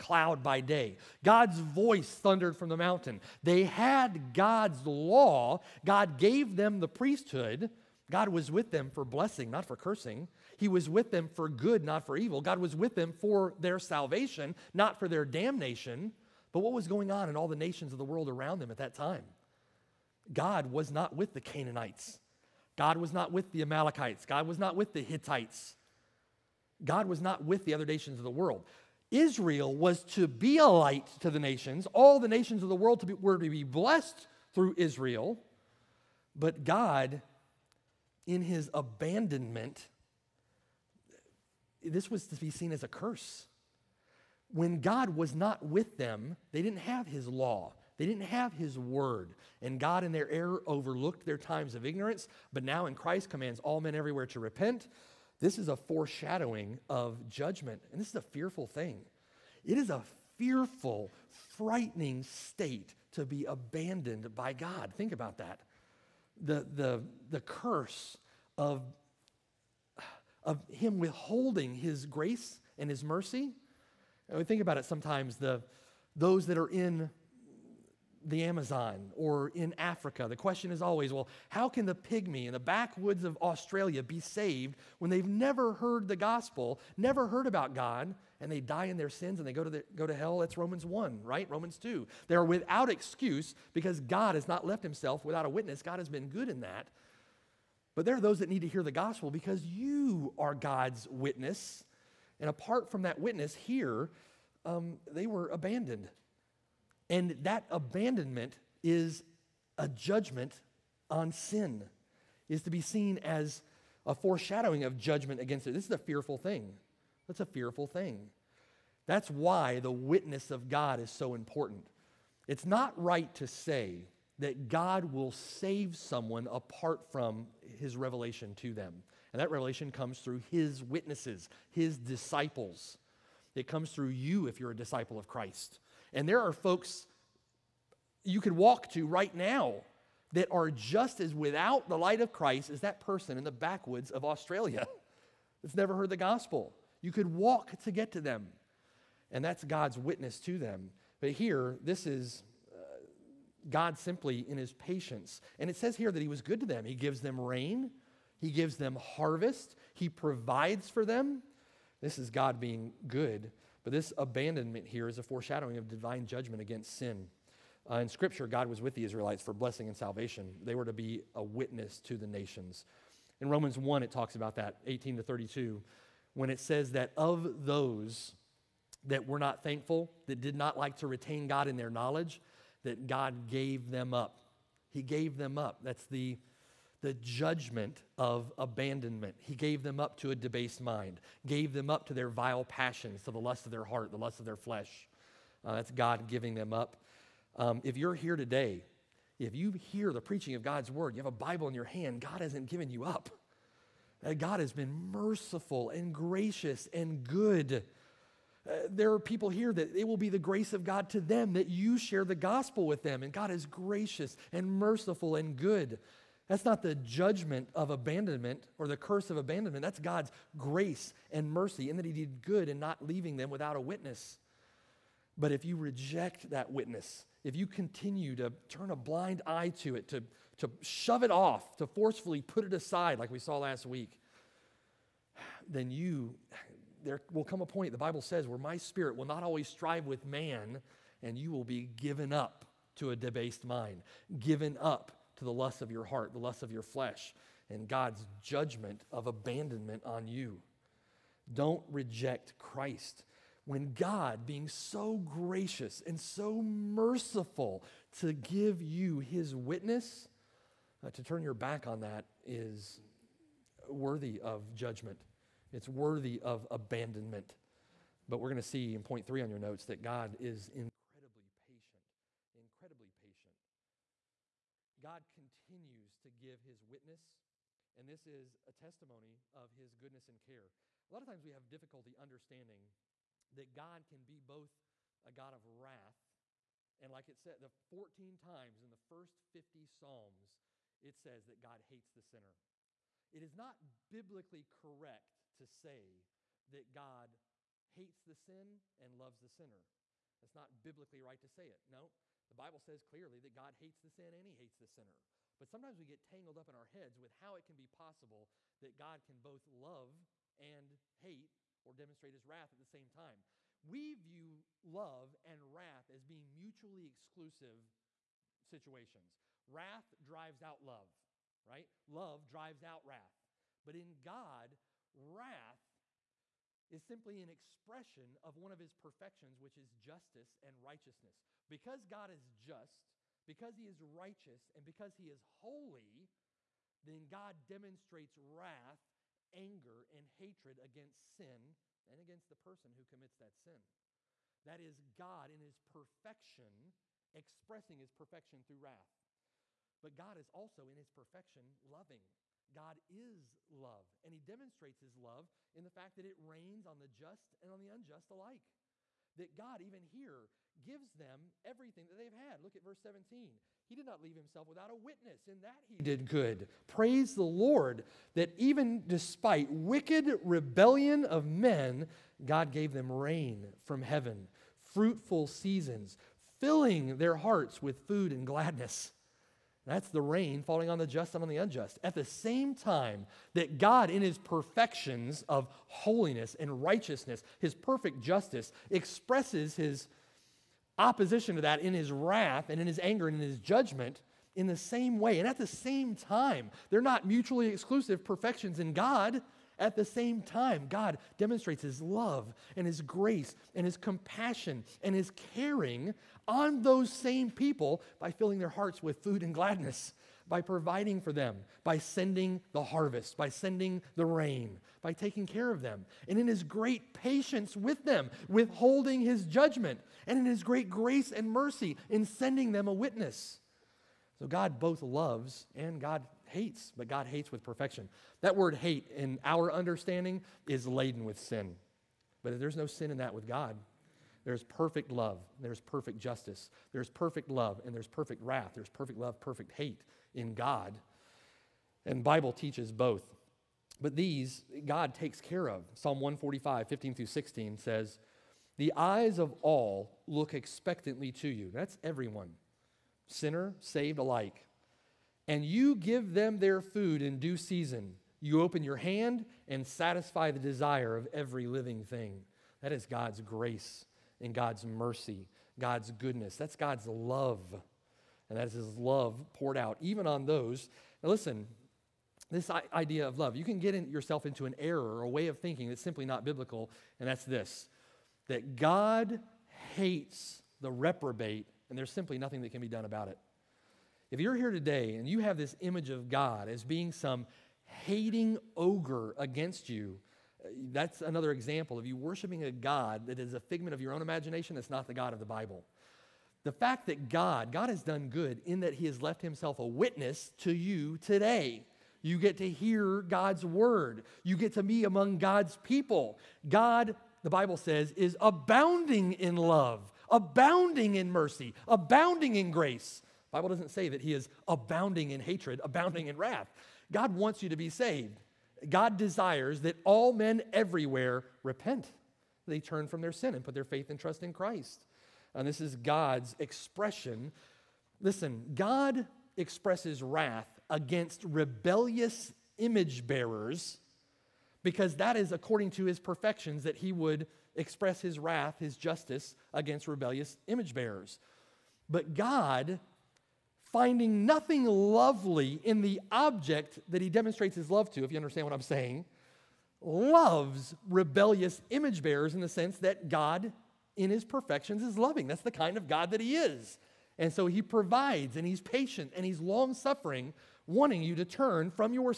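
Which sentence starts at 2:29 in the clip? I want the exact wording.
And that's God's witness to them.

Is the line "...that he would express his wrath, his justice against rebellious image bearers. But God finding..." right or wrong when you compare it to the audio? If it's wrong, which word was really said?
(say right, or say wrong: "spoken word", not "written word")
right.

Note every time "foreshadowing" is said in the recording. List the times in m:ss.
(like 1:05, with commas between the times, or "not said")
0:55, 1:54, 2:45.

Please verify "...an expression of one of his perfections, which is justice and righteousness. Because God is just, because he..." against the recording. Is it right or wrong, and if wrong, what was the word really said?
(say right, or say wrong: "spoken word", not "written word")
right.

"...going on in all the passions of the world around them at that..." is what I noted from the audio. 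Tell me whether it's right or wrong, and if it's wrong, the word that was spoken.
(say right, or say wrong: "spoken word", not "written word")
wrong: "nations", not "passions".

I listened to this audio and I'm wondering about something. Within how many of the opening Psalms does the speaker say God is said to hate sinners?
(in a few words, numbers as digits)
50.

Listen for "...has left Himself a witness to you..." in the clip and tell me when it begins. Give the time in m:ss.
8:19.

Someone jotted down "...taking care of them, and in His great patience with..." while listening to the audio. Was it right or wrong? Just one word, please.
right.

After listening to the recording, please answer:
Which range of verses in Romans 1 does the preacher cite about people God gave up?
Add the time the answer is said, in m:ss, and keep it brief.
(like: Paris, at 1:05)
18 to 32, at 2:54.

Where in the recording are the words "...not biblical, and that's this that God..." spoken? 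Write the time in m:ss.
7:56.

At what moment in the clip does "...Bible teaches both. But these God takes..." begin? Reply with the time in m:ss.
7:22.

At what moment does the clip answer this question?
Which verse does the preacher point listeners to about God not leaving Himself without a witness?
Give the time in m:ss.
6:02.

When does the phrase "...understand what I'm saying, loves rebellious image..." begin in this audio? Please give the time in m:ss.
9:08.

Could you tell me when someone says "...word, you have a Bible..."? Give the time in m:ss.
3:20.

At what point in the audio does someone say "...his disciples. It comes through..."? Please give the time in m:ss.
2:11.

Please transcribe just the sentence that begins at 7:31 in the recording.
That's everyone, sinner, saved alike and you give them their food in due season.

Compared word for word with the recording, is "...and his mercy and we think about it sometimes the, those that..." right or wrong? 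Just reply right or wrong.
right.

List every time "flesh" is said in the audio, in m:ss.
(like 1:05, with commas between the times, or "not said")
3:14, 4:06.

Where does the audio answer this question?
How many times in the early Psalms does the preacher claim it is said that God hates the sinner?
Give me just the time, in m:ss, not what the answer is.
4:47.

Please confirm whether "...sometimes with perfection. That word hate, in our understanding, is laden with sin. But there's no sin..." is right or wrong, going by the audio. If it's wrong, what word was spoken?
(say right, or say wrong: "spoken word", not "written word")
wrong: "hates", not "sometimes".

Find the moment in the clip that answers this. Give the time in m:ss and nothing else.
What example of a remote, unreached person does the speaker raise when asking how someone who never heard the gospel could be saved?
1:21.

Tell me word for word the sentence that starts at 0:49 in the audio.
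And God, in their error, overlooked their times of ignorance.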